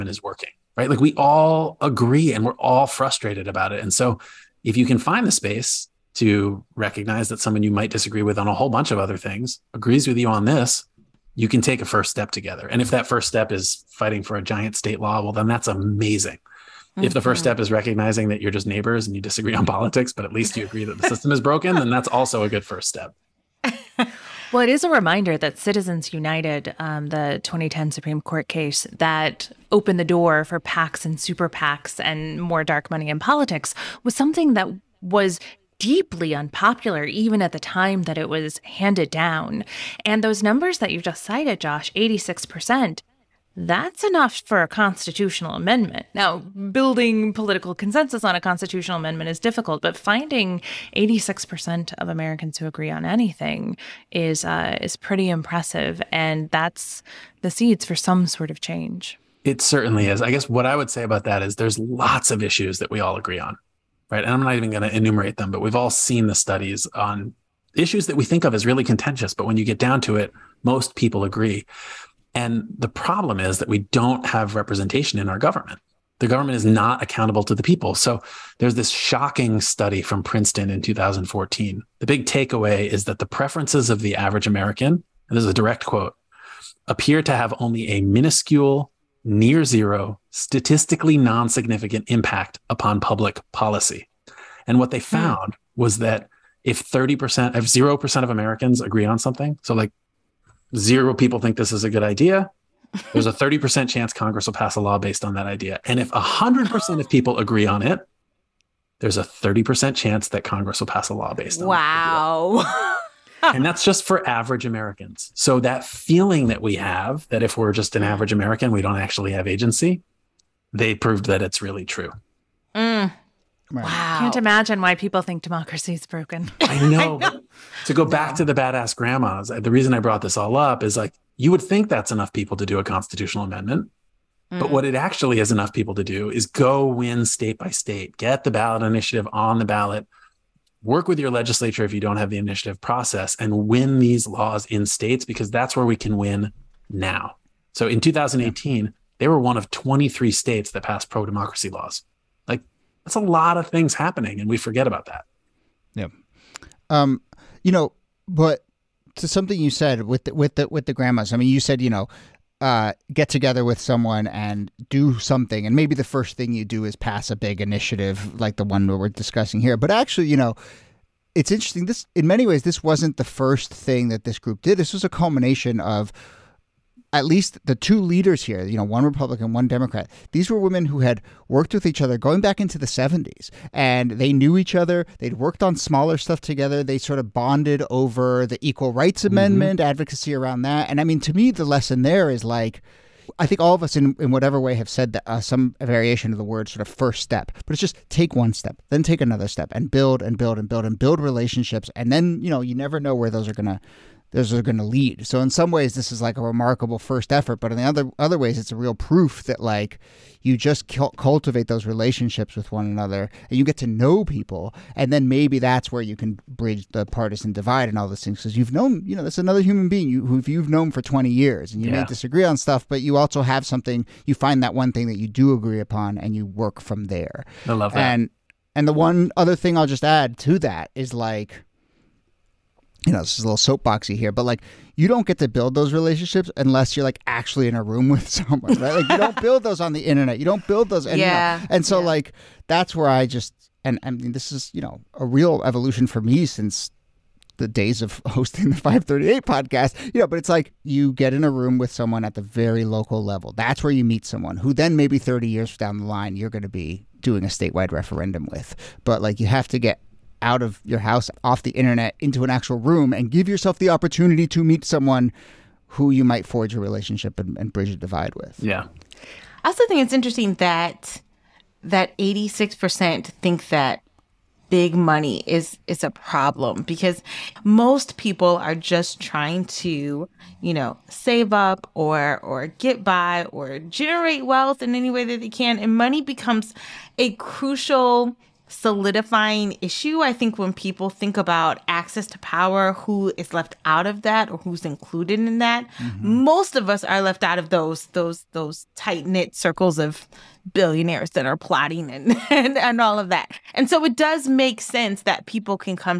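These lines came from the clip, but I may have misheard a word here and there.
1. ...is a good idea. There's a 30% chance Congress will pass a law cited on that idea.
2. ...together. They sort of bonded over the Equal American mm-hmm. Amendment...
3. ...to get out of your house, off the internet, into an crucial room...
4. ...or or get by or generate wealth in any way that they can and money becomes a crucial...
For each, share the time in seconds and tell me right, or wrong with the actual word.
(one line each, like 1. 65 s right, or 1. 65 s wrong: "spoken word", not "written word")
1. 101 s wrong: "based", not "cited"
2. 186 s wrong: "Rights", not "American"
3. 259 s wrong: "actual", not "crucial"
4. 281 s right.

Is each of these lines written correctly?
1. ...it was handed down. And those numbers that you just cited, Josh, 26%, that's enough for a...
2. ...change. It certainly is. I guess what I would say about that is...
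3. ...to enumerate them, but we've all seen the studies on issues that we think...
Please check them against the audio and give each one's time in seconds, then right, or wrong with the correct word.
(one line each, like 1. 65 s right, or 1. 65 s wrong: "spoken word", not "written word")
1. 38 s wrong: "86", not "26"
2. 58 s right
3. 64 s right.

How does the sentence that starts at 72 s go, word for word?
And the problem is that we don't have representation in our government.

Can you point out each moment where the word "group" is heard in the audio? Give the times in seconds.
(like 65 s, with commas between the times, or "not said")
174 s.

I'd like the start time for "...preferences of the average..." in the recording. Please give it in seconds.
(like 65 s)
83 s.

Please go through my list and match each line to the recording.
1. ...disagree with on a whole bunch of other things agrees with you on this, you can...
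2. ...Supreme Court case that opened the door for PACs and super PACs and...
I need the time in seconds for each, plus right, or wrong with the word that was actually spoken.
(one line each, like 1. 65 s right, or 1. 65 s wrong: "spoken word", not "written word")
1. 7 s right
2. 27 s right.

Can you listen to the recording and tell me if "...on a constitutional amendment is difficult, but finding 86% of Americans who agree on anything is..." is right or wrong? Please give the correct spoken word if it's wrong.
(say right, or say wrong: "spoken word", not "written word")
right.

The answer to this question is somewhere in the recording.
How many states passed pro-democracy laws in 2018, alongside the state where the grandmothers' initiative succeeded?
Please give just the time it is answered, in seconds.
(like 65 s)
149 s.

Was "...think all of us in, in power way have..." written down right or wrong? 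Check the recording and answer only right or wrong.
wrong.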